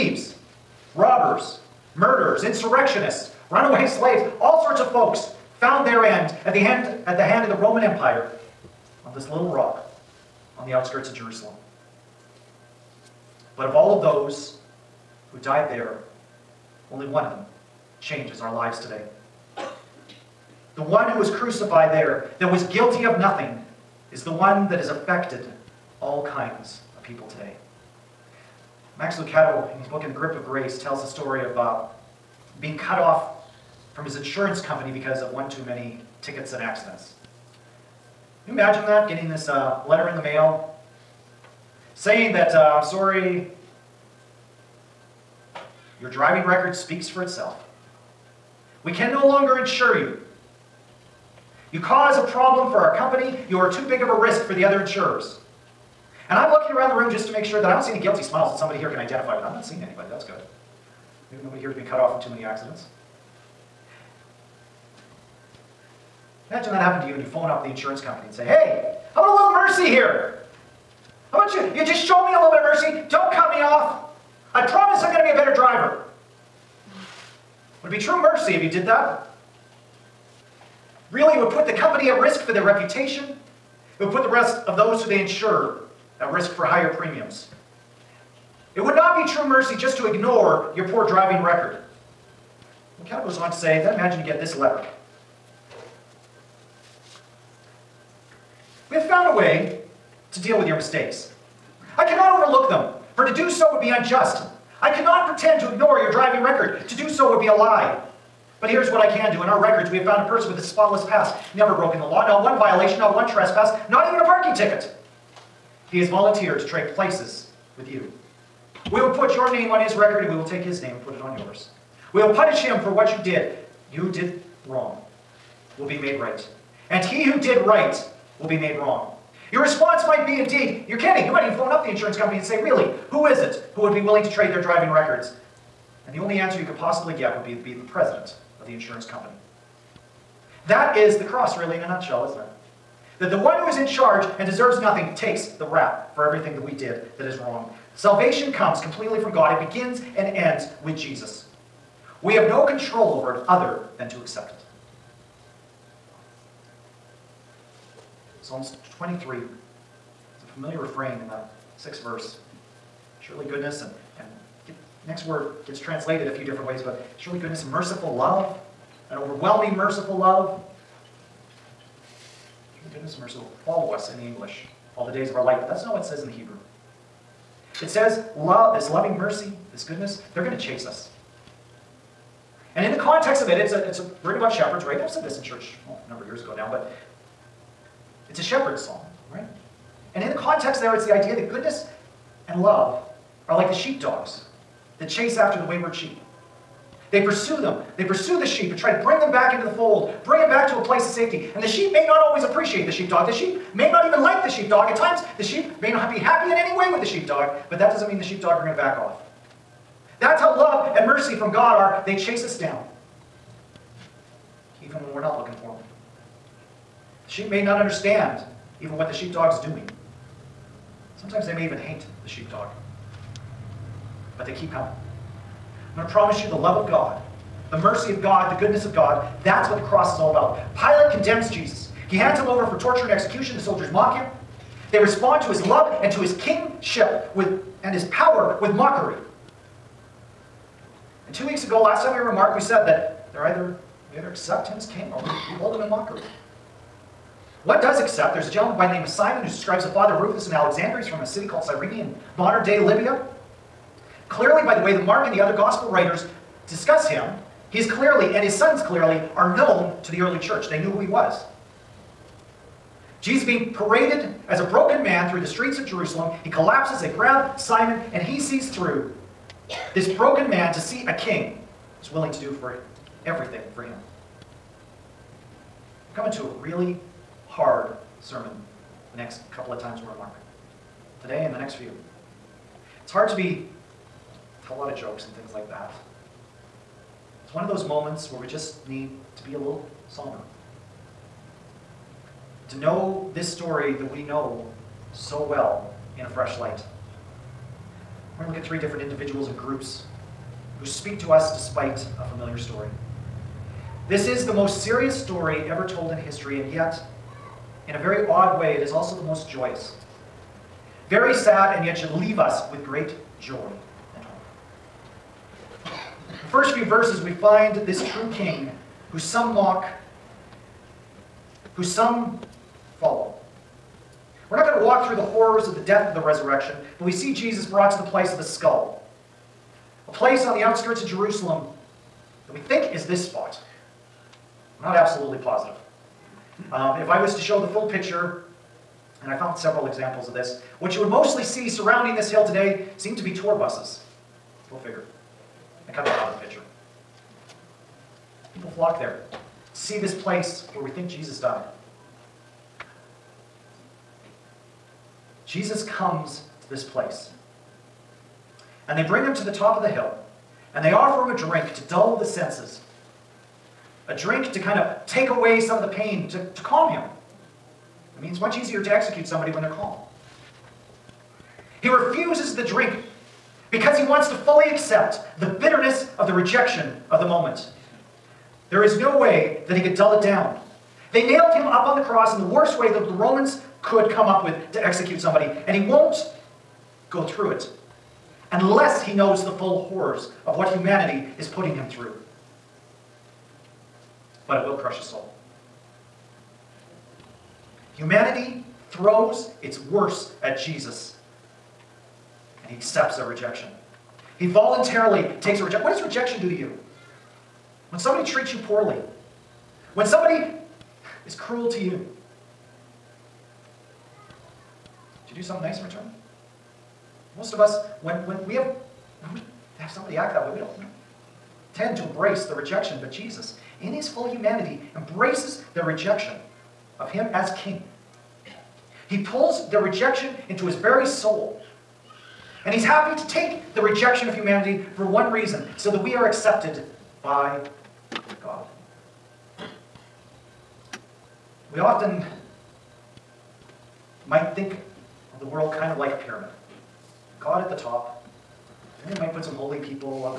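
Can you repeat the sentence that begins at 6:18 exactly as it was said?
There is no way that he could dull it down.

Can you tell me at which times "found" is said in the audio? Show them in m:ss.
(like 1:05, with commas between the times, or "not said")
0:05, 1:50, 5:39.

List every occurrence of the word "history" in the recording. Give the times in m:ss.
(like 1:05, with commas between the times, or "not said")
5:06.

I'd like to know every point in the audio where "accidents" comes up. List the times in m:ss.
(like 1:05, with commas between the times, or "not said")
0:36, 1:02.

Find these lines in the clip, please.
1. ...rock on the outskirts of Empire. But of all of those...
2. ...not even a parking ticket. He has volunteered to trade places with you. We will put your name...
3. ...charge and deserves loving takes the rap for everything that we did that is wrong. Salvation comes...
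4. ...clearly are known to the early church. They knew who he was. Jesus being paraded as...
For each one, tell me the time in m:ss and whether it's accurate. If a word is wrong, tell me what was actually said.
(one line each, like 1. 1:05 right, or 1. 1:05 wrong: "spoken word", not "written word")
1. 0:09 wrong: "Jerusalem", not "Empire"
2. 1:53 right
3. 2:23 wrong: "nothing", not "loving"
4. 4:18 right.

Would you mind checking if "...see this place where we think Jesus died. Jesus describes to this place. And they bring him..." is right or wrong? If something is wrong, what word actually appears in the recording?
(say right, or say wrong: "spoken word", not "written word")
wrong: "comes", not "describes".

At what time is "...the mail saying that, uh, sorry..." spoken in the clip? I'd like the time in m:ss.
0:40.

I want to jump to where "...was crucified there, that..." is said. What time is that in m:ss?
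0:21.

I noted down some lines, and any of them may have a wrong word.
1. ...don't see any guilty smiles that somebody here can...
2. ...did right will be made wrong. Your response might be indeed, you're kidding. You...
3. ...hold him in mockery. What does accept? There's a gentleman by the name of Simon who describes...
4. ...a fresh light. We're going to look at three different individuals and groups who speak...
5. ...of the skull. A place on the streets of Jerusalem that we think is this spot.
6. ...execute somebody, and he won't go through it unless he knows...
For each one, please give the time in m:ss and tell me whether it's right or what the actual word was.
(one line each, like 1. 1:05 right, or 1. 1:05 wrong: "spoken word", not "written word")
1. 0:57 right
2. 2:07 right
3. 4:05 right
4. 4:56 right
5. 5:28 wrong: "outskirts", not "streets"
6. 6:24 right.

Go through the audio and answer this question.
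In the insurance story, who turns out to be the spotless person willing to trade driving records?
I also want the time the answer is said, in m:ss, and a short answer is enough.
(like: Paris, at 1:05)
The president of the insurance company, at 2:17.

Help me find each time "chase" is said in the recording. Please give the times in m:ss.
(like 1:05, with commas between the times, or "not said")
3:00, 3:15, 3:32.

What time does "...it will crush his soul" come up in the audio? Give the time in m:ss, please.
6:34.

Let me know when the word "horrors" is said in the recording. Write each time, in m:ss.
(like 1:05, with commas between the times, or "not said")
5:25, 6:29.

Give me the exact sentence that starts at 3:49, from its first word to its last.
That's what the cross is all about.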